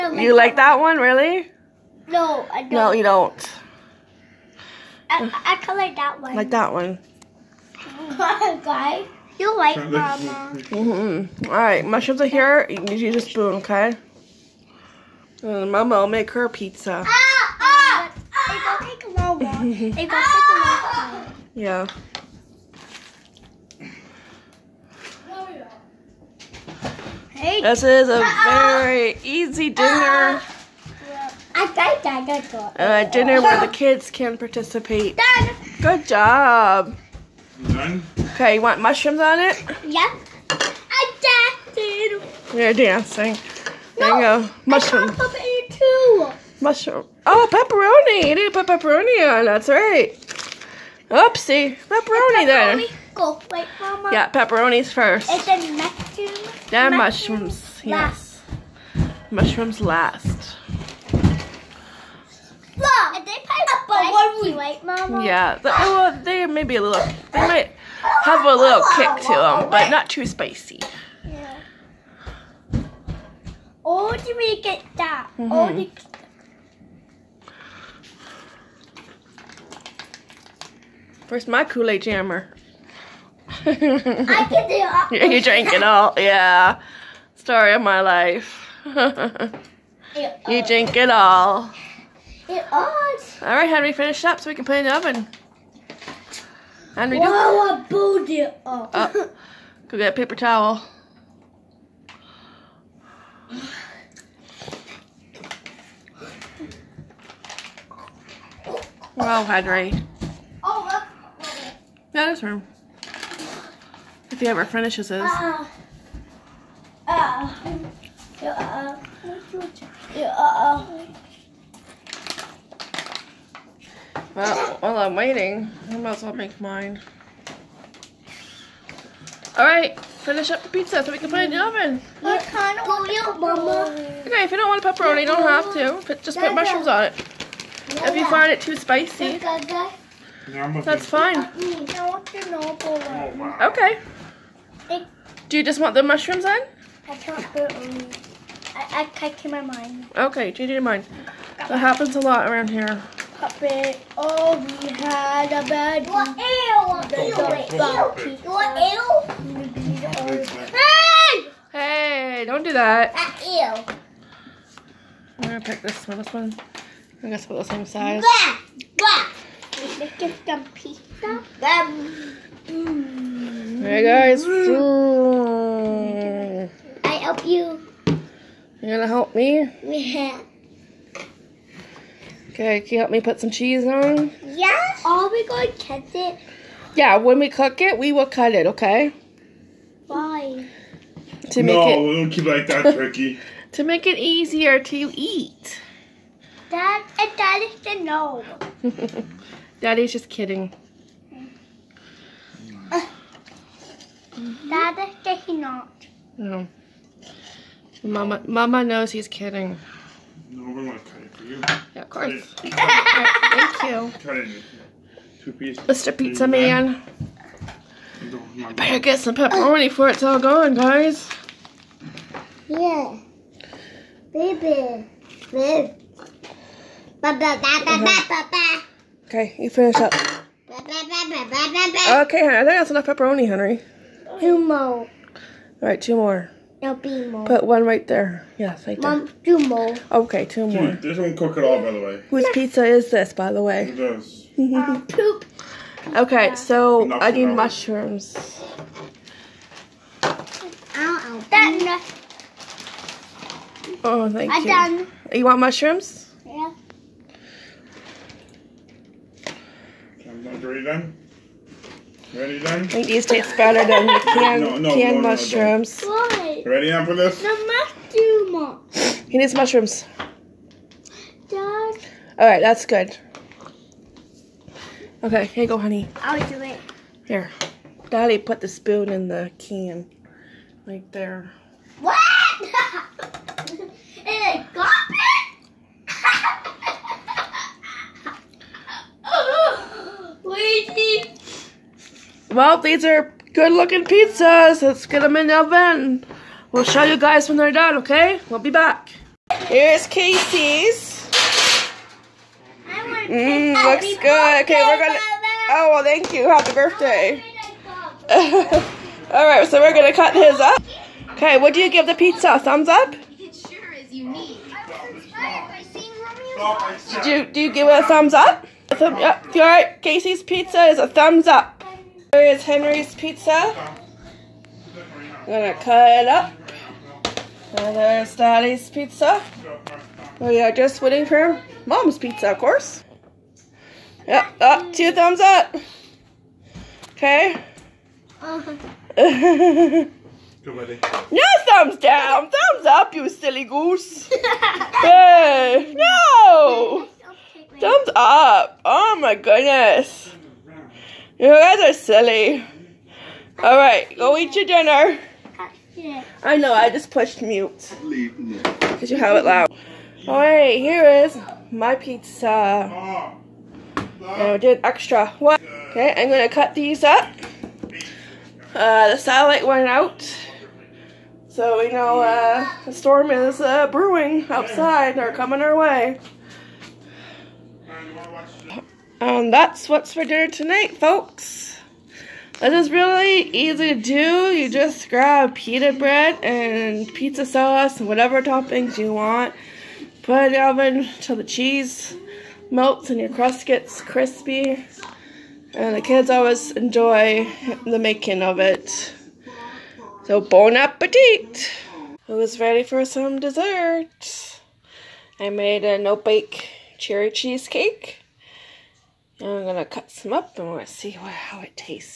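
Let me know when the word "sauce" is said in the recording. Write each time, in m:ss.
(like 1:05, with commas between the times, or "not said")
6:27.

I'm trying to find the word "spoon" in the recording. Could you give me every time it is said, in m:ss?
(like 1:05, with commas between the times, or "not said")
0:13, 4:38.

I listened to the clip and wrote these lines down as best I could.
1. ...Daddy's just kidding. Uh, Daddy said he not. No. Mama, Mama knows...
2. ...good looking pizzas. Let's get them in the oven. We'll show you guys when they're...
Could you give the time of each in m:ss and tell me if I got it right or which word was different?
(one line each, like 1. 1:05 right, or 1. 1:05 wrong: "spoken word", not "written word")
1. 3:19 right
2. 4:53 right.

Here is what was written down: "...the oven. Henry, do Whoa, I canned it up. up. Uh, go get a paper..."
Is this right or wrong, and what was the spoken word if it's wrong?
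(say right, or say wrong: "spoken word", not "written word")
wrong: "pulled", not "canned".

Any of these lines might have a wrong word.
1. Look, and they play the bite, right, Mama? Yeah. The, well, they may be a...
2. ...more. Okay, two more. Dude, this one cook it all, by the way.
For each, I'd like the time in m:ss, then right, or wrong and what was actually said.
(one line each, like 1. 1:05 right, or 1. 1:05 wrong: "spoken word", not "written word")
1. 1:02 right
2. 3:59 right.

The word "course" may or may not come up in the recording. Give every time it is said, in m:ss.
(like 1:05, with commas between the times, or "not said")
3:32, 5:32.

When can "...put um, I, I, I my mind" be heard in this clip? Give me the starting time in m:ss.
2:27.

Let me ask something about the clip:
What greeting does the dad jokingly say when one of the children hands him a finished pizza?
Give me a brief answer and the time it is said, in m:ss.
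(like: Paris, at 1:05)
Happy birthday, at 5:06.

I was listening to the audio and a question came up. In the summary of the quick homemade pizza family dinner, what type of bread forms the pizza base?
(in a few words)
pita bread.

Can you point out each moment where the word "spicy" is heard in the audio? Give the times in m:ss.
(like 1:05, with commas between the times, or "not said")
1:10, 2:18.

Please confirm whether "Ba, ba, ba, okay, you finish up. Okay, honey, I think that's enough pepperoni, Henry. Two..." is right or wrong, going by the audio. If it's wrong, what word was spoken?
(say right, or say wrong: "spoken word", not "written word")
right.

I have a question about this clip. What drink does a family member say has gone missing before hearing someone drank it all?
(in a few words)
Kool-Aid Jammer.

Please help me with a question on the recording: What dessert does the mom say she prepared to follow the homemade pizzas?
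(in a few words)
no-bake cherry cheesecake.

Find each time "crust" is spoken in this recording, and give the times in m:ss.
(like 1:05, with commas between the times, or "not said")
6:33.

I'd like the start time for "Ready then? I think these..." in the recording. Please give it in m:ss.
4:22.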